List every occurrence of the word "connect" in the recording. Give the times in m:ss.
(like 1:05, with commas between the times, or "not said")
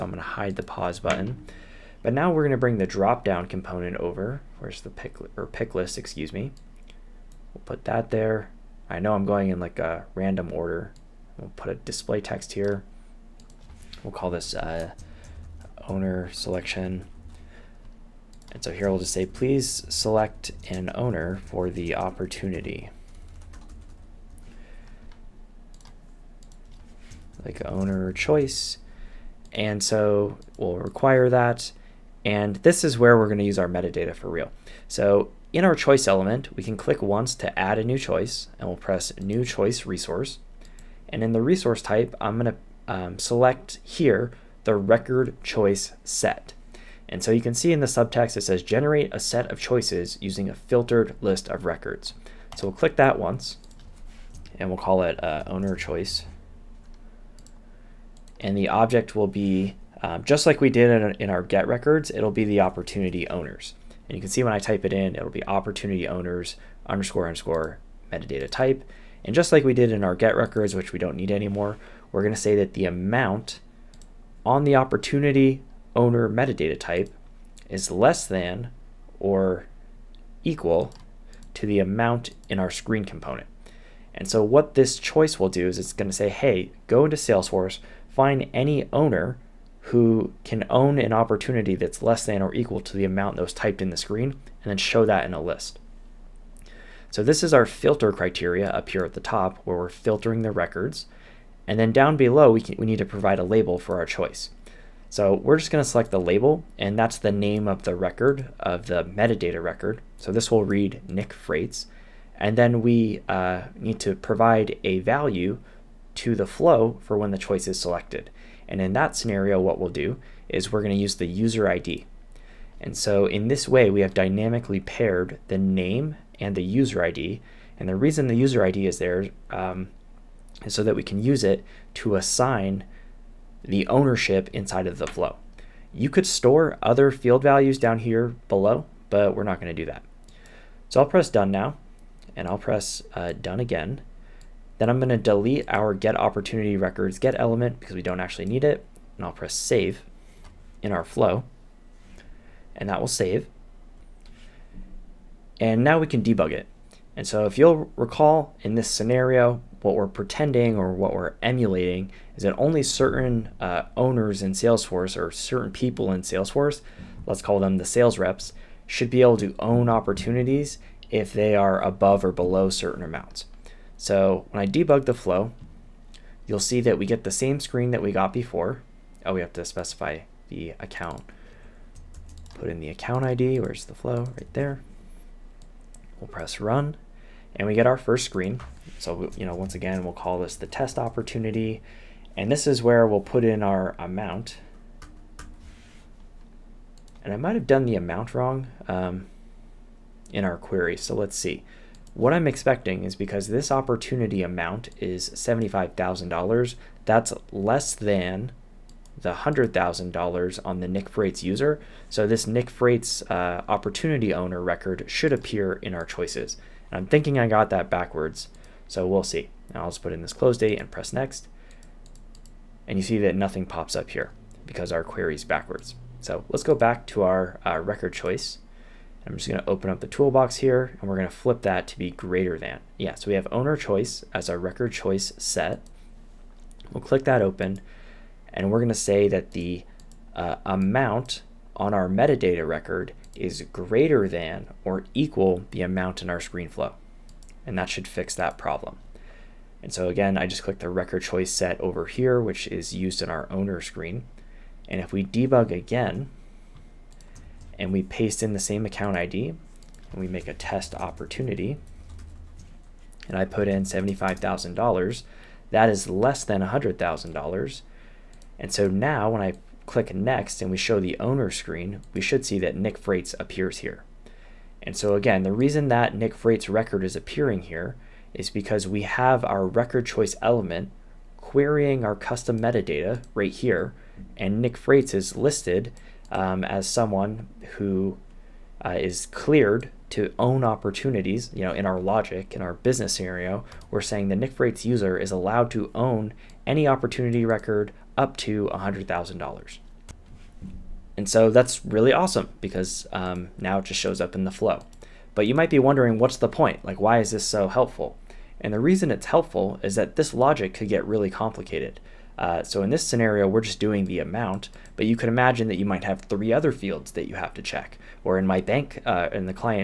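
not said.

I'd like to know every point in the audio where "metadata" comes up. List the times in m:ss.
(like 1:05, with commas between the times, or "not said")
0:33, 1:08, 1:16, 1:49, 4:02, 4:42.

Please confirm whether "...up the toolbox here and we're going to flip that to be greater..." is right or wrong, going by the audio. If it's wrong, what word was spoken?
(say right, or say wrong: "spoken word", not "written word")
right.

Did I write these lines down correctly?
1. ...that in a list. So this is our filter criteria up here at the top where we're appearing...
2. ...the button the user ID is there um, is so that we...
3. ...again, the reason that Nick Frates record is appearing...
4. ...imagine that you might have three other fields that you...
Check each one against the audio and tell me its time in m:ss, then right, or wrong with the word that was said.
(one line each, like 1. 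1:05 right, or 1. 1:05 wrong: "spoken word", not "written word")
1. 1:35 wrong: "filtering", not "appearing"
2. 2:07 wrong: "reason", not "button"
3. 4:35 right
4. 5:15 right.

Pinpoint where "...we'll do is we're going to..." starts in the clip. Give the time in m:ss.
1:59.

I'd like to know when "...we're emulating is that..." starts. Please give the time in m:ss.
2:41.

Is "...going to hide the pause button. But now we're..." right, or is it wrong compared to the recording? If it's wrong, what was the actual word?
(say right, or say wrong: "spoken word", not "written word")
right.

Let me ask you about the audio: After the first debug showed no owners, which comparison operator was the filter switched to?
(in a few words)
Greater than or equal.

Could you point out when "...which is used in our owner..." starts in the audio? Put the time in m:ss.
4:12.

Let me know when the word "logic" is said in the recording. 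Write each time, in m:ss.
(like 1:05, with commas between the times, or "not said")
4:52, 5:10.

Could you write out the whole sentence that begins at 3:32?
So this Nick Frates uh, opportunity owner record should appear in our choices.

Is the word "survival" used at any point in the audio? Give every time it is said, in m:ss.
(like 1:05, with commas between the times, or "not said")
not said.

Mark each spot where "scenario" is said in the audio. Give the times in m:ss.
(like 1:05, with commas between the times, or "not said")
1:59, 2:38, 4:53, 5:13.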